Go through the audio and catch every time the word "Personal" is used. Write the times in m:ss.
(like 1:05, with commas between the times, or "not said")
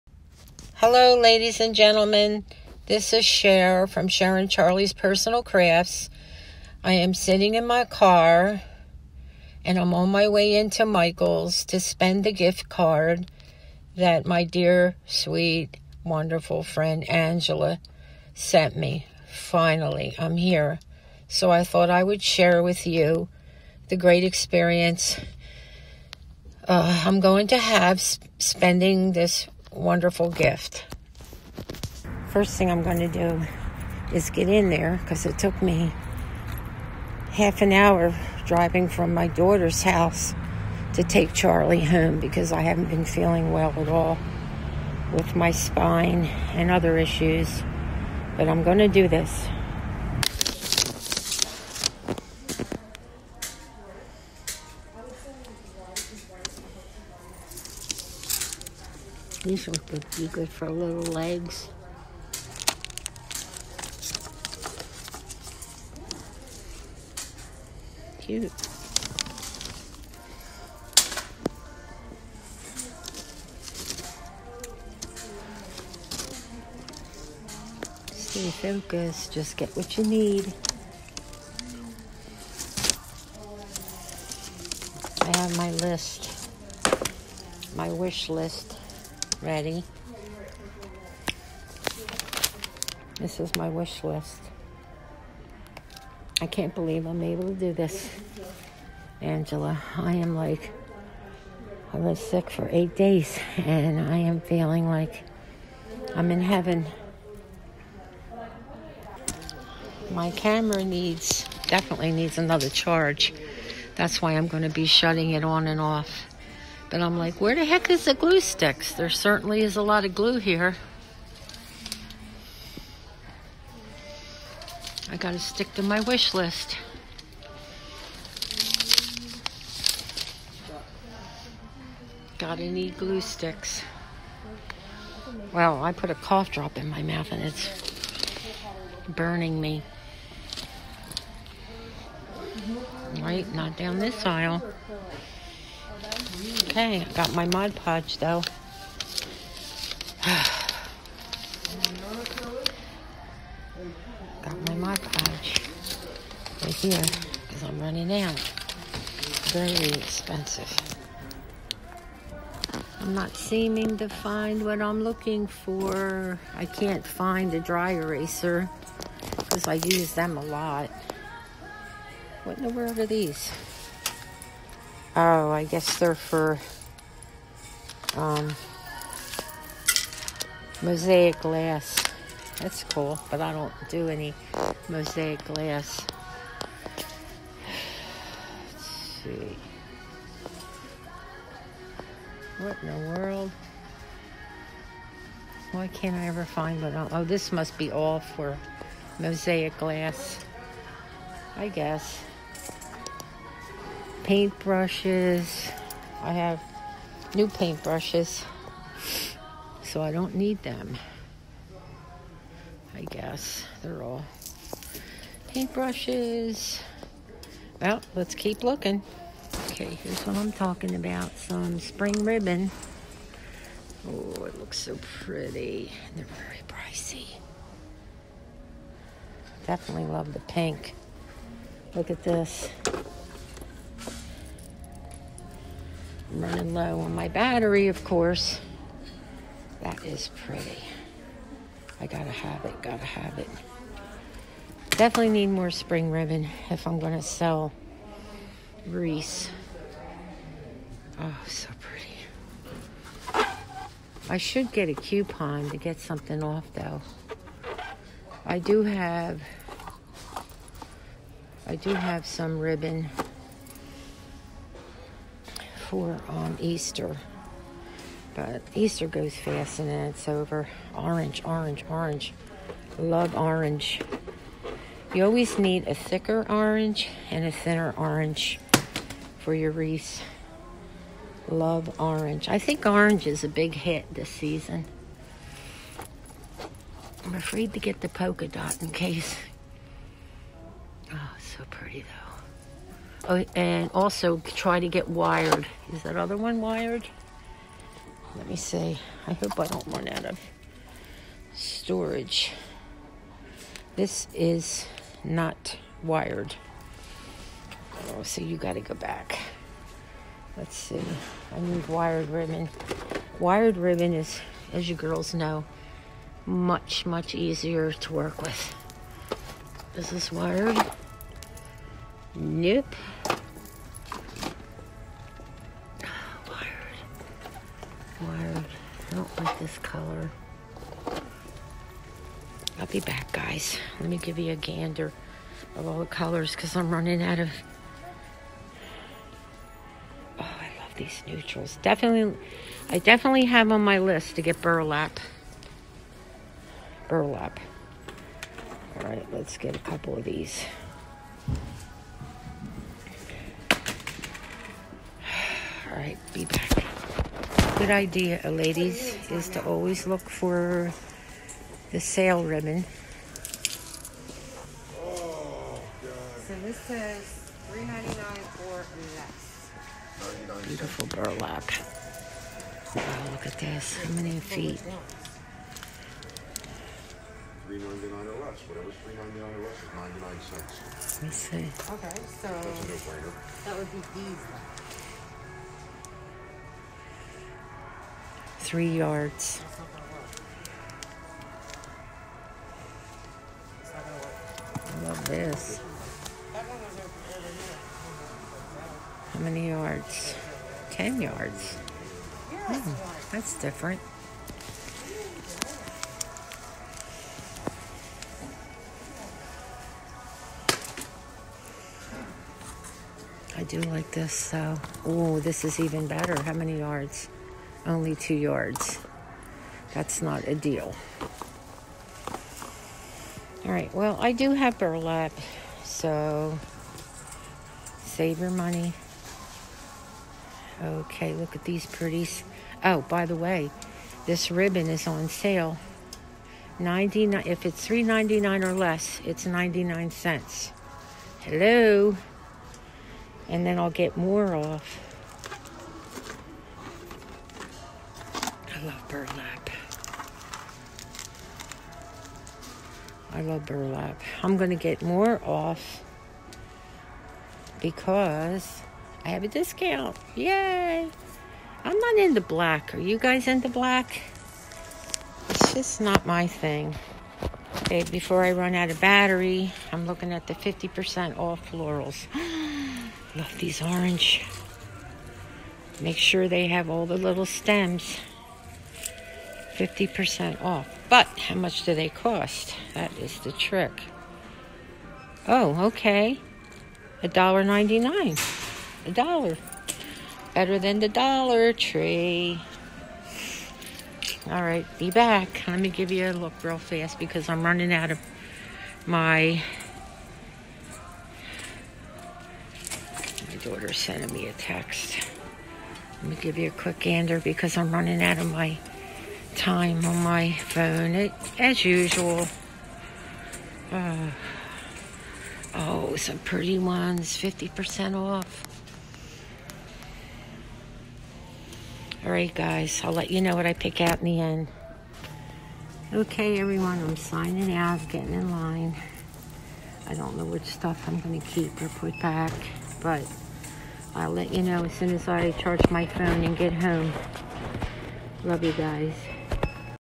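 0:04.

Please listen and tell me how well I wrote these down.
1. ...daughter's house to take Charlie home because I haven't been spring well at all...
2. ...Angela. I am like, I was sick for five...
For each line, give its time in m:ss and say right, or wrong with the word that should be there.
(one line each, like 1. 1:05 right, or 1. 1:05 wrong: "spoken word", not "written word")
1. 0:39 wrong: "feeling", not "spring"
2. 1:39 wrong: "eight", not "five".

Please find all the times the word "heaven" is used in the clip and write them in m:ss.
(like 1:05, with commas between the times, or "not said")
1:46.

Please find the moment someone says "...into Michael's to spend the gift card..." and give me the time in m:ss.
0:10.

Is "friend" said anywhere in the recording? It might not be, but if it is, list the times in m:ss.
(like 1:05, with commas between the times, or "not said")
0:16.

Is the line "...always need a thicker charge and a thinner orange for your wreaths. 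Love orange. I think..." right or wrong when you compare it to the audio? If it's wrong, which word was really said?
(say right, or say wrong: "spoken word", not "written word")
wrong: "orange", not "charge".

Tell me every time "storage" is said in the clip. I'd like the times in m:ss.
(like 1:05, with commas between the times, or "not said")
5:01.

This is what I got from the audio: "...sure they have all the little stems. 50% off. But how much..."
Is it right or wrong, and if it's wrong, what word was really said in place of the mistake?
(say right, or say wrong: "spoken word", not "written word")
right.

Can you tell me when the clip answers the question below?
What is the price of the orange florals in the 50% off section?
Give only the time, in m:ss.
8:07.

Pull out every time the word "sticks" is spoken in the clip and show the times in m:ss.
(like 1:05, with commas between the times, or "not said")
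1:58, 2:05, 2:13.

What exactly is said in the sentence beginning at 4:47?
I'm afraid to get the polka dot in case.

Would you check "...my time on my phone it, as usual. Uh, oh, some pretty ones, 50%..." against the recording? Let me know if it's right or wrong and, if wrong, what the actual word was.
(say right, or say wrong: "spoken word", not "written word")
right.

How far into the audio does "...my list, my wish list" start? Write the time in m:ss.
1:25.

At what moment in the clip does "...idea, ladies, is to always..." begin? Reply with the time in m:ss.
5:57.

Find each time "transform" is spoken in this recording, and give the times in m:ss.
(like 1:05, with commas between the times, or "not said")
not said.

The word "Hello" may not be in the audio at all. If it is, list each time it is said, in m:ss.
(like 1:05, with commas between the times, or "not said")
0:00, 7:21.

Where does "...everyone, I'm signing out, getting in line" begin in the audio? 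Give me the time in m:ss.
8:46.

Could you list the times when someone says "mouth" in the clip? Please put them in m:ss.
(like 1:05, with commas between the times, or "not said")
2:17.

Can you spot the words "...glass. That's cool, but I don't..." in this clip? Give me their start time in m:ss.
3:01.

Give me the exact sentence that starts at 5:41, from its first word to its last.
Definitely, I definitely have on my list to get burlap.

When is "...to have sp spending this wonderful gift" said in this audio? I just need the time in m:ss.
0:27.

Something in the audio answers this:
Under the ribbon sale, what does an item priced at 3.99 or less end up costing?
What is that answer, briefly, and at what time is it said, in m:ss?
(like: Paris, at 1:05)
99 cents, at 6:19.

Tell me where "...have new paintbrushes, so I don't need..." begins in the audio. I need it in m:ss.
3:26.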